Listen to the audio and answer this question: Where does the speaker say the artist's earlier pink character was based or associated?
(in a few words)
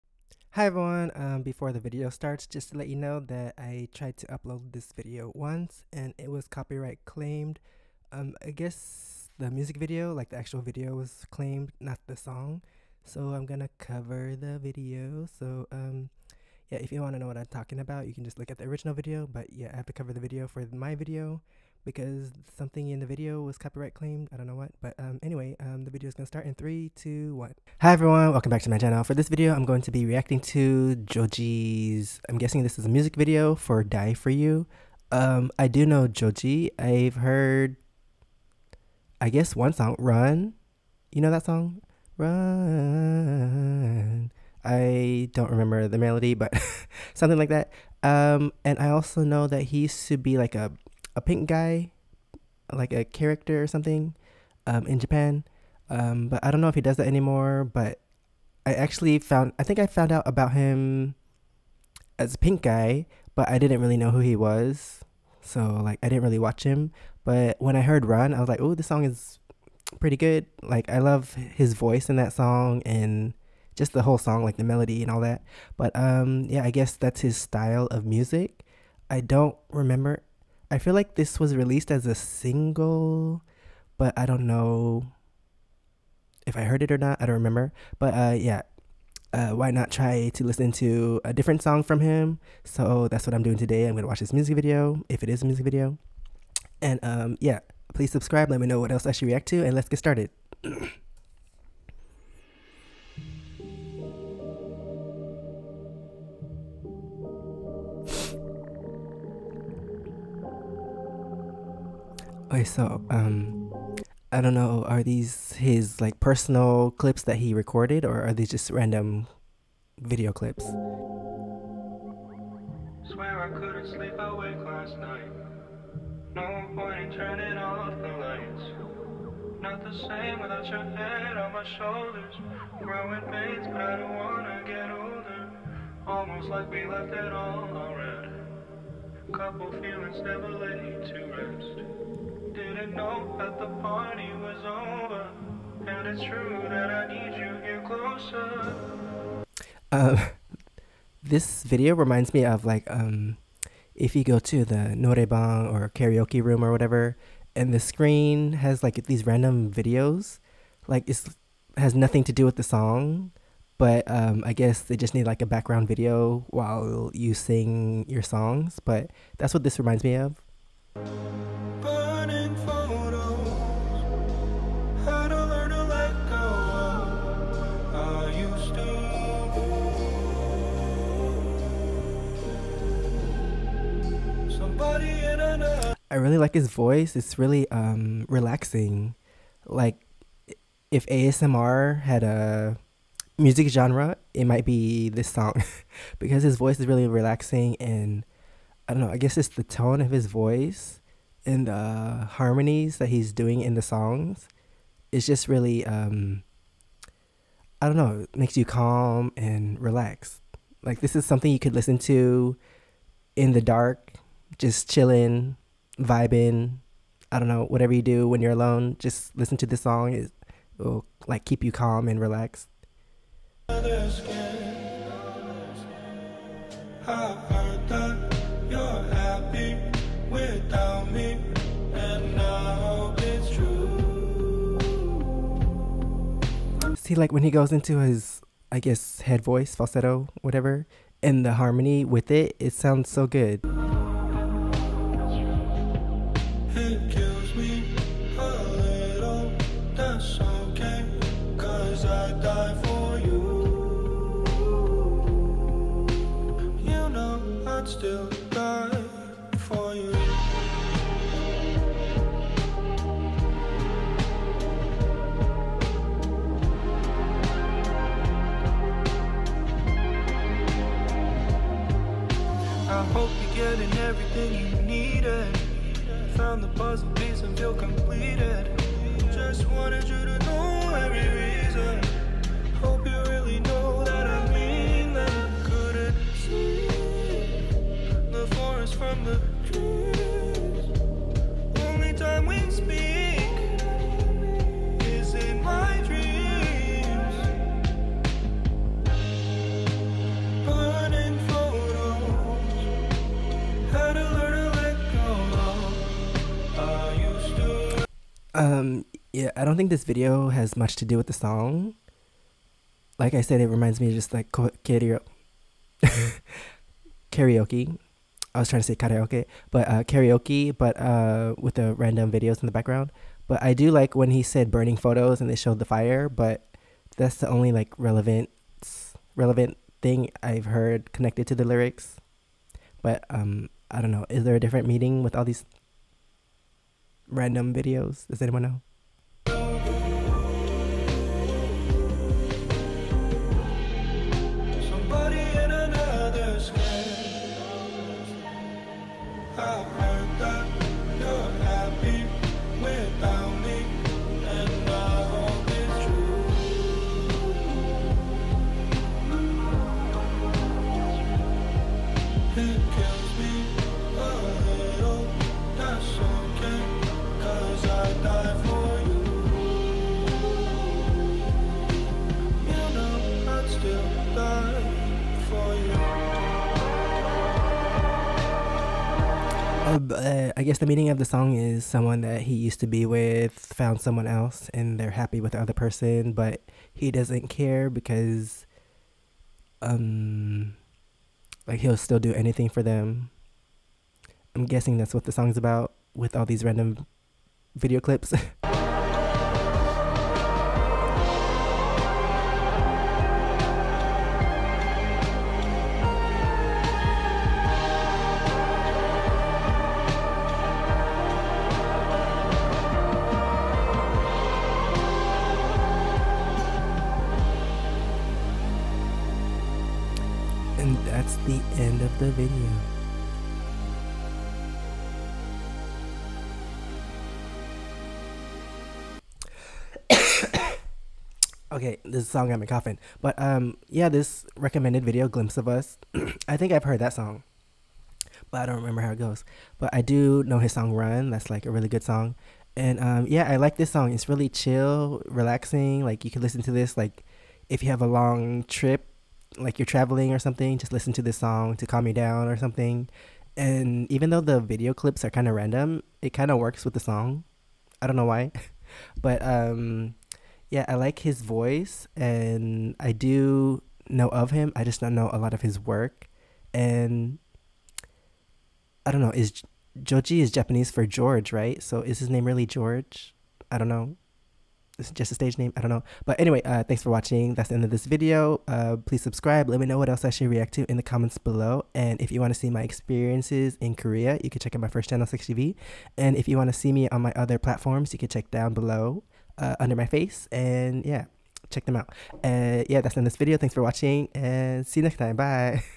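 Japan.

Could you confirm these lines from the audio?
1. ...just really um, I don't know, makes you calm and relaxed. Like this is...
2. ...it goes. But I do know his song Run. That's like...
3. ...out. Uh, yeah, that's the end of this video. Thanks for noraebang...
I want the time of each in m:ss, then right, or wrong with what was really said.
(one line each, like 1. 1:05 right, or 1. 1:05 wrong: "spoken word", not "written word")
1. 3:25 right
2. 7:19 right
3. 8:11 wrong: "watching", not "noraebang".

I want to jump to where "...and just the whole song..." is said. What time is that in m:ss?
1:12.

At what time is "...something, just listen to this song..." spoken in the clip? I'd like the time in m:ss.
7:30.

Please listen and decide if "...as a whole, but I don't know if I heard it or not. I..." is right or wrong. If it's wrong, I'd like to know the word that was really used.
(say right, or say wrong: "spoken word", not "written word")
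wrong: "single", not "whole".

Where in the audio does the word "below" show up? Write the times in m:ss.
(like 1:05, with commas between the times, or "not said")
8:01, 8:08.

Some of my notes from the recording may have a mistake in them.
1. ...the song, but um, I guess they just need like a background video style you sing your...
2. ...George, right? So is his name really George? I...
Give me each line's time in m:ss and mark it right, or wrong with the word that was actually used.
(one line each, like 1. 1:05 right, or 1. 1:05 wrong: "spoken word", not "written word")
1. 2:42 wrong: "while", not "style"
2. 7:51 right.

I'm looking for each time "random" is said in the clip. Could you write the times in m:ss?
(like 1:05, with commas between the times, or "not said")
1:58, 2:39, 5:21, 5:37, 6:36, 7:35.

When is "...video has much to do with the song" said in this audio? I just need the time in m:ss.
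5:10.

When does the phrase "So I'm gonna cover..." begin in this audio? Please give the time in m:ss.
0:13.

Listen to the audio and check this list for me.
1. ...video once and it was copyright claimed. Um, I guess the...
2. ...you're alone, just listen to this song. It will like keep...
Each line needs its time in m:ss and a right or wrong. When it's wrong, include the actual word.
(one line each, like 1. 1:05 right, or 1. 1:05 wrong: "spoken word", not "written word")
1. 0:04 right
2. 3:38 right.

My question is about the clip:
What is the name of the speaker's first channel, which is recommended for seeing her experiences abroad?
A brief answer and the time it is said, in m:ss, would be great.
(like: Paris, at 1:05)
SEKSHI V, at 8:05.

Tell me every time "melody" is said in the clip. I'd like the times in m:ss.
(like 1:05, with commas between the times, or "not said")
0:45, 1:14.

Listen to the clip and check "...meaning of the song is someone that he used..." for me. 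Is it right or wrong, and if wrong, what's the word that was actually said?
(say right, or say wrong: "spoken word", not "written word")
right.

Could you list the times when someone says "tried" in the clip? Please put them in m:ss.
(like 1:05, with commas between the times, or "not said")
0:03.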